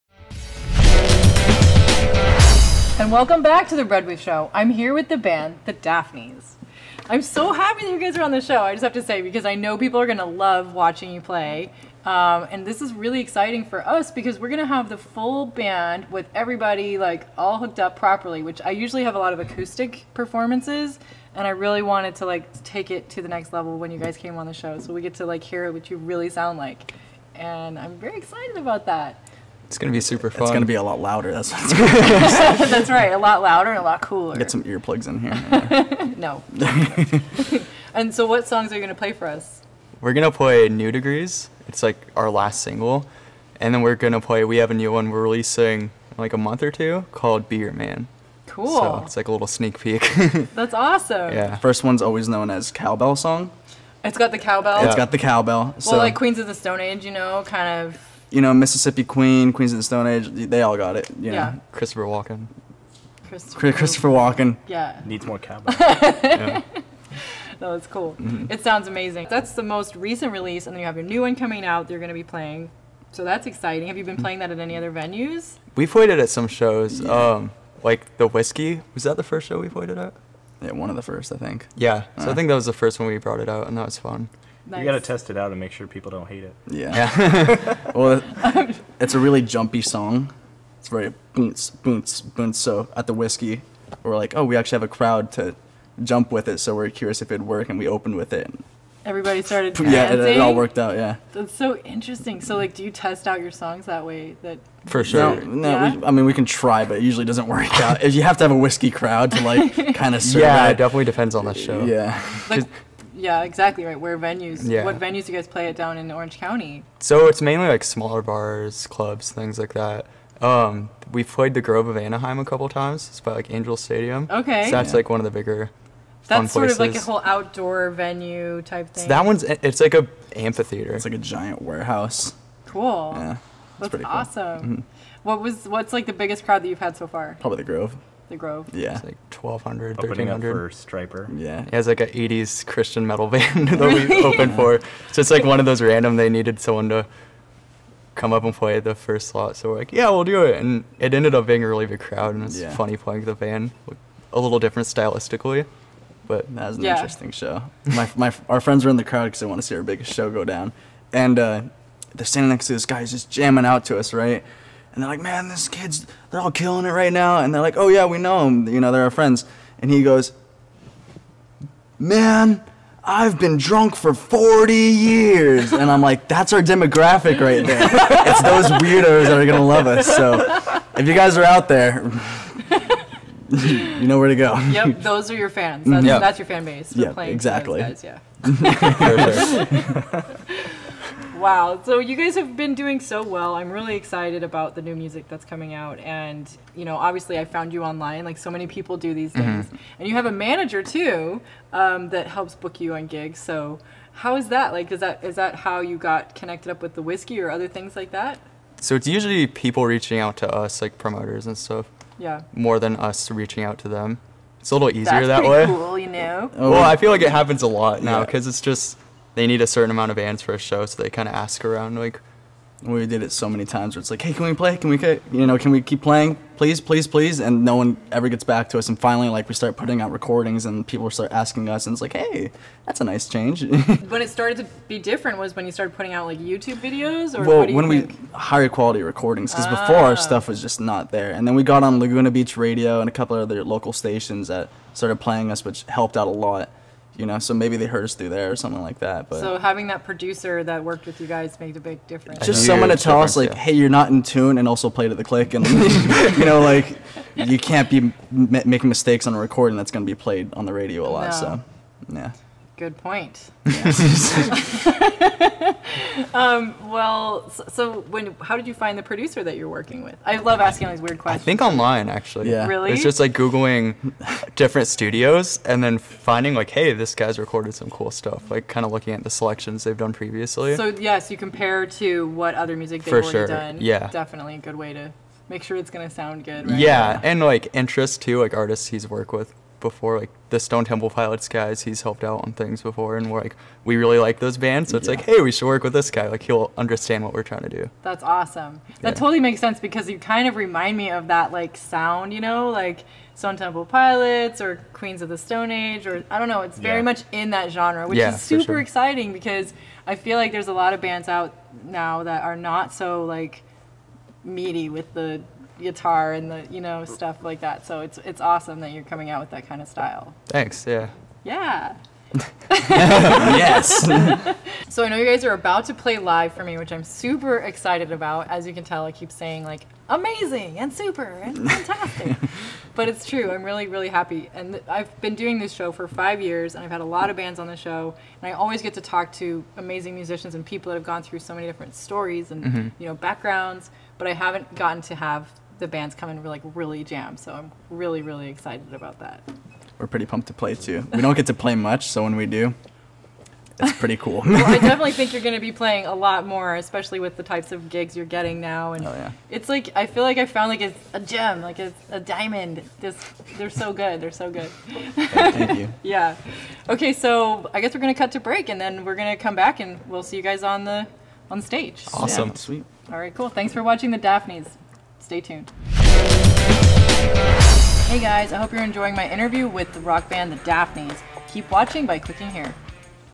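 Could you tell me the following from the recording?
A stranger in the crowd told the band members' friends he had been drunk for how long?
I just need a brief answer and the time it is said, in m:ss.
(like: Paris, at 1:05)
40 years, at 2:54.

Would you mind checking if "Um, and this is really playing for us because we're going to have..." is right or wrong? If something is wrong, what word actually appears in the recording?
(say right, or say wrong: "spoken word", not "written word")
wrong: "exciting", not "playing".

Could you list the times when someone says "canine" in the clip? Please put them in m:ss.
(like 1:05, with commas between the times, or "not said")
not said.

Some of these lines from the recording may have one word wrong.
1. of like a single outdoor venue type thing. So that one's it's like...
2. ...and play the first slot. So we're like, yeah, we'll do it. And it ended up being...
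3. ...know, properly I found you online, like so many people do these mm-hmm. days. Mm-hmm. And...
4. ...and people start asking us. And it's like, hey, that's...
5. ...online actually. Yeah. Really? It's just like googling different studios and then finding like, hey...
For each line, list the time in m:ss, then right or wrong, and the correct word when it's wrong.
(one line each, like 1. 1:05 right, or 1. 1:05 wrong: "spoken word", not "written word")
1. 2:06 wrong: "whole", not "single"
2. 2:28 right
3. 3:16 wrong: "obviously", not "properly"
4. 3:50 right
5. 4:31 right.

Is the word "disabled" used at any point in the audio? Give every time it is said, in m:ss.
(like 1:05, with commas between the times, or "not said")
not said.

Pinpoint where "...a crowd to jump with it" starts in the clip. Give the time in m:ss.
1:34.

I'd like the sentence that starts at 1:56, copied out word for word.
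So it's mainly like smaller bars, clubs, things like that.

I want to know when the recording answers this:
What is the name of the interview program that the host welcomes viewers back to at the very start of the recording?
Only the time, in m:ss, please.
0:03.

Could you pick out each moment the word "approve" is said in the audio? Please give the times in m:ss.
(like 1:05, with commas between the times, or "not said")
not said.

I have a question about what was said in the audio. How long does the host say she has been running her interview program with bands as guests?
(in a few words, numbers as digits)
5 years.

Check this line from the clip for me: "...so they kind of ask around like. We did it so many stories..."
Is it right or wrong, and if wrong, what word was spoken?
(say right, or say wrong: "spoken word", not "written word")
wrong: "times", not "stories".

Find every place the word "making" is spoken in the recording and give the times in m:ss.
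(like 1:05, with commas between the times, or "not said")
4:18.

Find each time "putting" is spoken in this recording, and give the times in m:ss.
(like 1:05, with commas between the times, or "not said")
3:49, 3:55.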